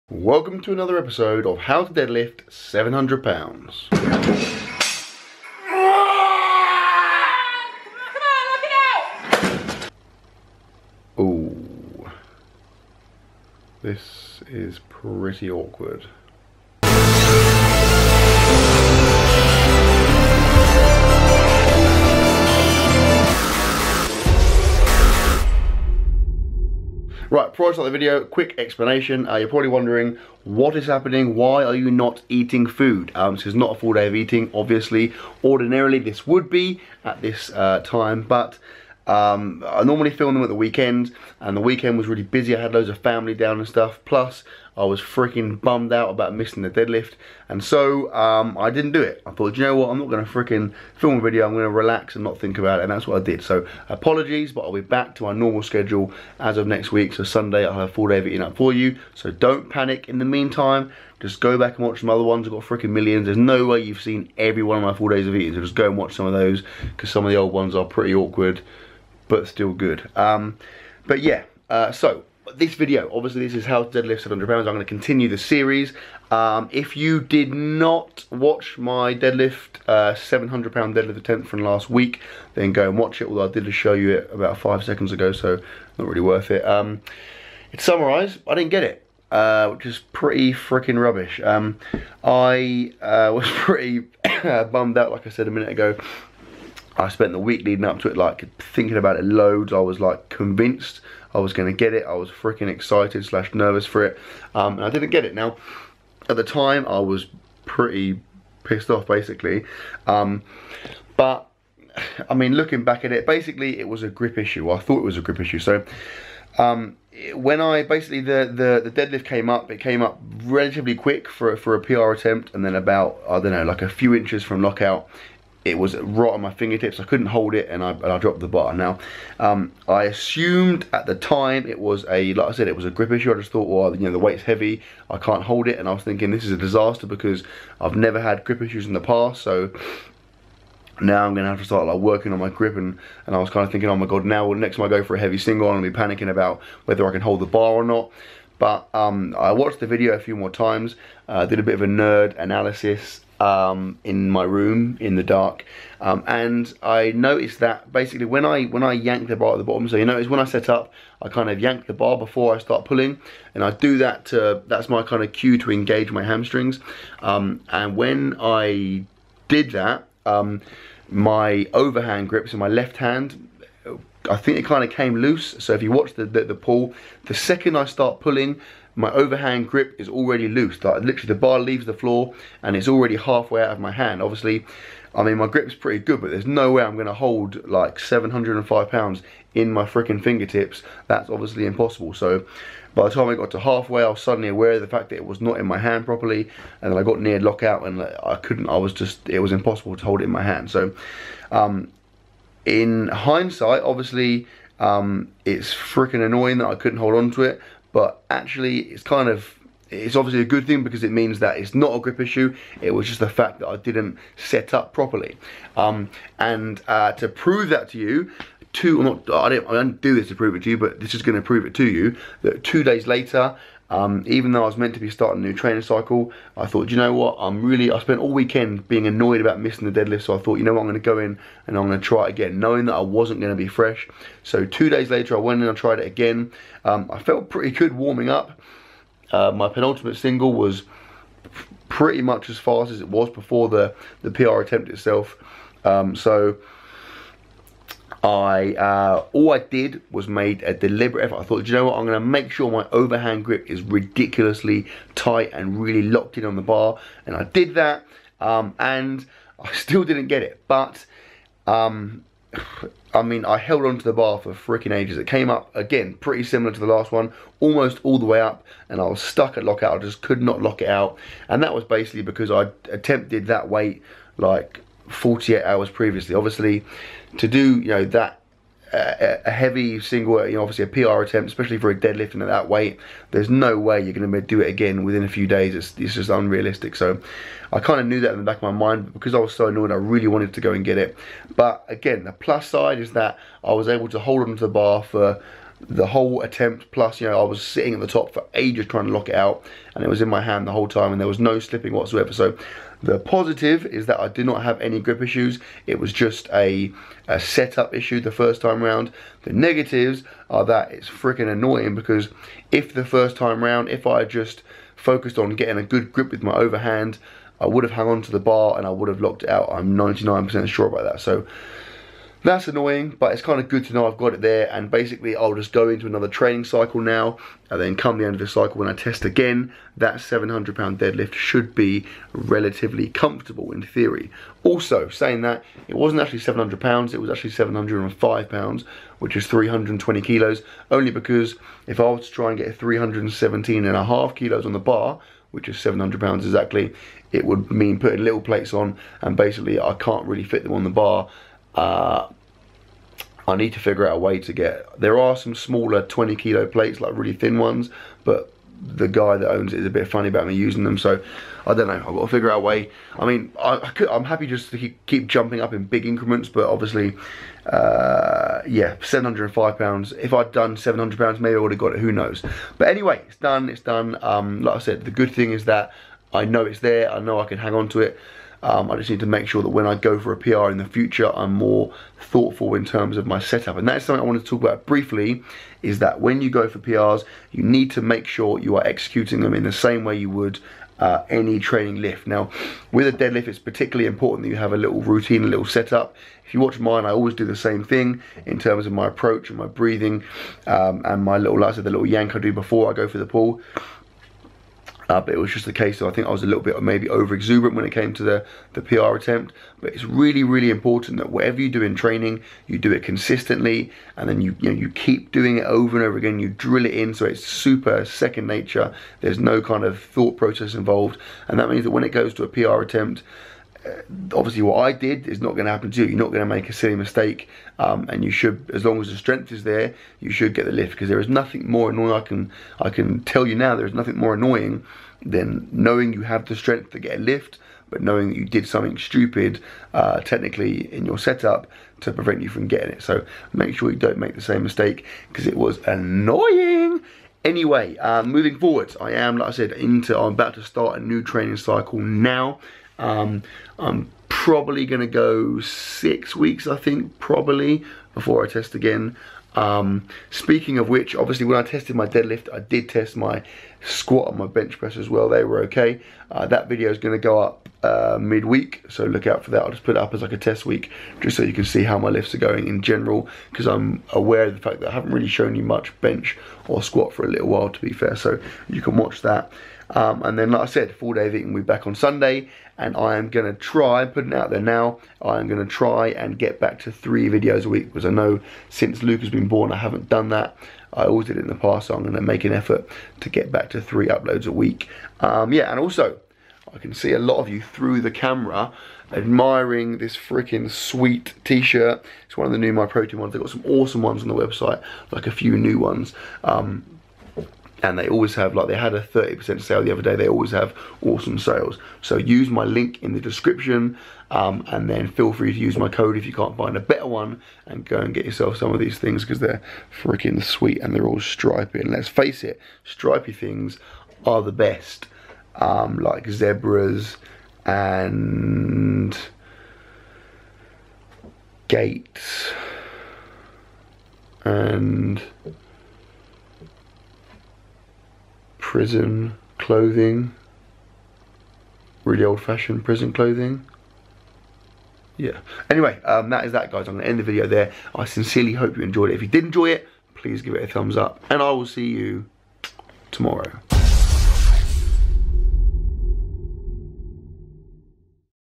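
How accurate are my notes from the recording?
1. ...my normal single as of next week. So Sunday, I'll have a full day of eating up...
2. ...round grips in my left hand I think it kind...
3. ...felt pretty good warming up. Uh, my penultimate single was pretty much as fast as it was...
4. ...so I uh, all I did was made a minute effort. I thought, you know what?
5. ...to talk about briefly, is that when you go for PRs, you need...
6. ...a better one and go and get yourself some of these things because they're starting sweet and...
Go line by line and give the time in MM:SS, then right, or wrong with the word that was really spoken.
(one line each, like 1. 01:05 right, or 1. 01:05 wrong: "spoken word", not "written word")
1. 00:55 wrong: "schedule", not "single"
2. 02:51 wrong: "overhand", not "round"
3. 03:57 right
4. 04:06 wrong: "deliberate", not "minute"
5. 06:24 right
6. 08:36 wrong: "freaking", not "starting".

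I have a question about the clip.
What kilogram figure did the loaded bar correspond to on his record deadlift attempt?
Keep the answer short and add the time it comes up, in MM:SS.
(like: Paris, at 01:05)
320 kilos, at 05:39.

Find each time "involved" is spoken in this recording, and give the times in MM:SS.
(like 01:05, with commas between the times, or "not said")
07:00.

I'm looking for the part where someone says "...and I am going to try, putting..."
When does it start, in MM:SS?
08:02.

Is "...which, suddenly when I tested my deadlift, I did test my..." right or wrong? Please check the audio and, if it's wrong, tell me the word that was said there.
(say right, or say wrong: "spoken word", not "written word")
wrong: "obviously", not "suddenly".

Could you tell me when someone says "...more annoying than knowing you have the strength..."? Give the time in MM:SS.
07:14.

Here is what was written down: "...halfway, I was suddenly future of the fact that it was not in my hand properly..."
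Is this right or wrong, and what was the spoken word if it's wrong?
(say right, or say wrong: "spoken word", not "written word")
wrong: "aware", not "future".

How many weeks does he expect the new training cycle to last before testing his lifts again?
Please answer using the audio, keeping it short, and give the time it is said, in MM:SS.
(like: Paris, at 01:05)
6 weeks, at 07:35.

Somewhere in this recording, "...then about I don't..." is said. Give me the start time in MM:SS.
02:02.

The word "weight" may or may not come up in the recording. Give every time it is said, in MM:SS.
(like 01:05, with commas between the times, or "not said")
02:14, 04:33, 04:42.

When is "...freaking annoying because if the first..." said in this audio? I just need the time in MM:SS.
05:11.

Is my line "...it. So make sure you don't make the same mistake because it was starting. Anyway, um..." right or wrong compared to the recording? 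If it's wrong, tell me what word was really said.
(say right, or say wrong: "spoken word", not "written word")
wrong: "annoying", not "starting".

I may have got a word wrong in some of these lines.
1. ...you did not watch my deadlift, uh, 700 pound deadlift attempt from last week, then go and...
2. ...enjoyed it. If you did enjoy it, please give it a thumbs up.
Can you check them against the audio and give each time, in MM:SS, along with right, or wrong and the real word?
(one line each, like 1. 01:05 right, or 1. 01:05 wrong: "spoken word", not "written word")
1. 01:16 right
2. 09:08 right.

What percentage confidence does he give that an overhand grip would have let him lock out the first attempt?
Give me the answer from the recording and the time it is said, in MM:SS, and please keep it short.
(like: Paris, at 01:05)
99%, at 05:19.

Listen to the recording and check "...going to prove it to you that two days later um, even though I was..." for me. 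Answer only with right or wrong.
right.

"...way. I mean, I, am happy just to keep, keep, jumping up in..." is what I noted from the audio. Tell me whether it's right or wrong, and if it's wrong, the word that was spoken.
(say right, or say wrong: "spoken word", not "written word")
right.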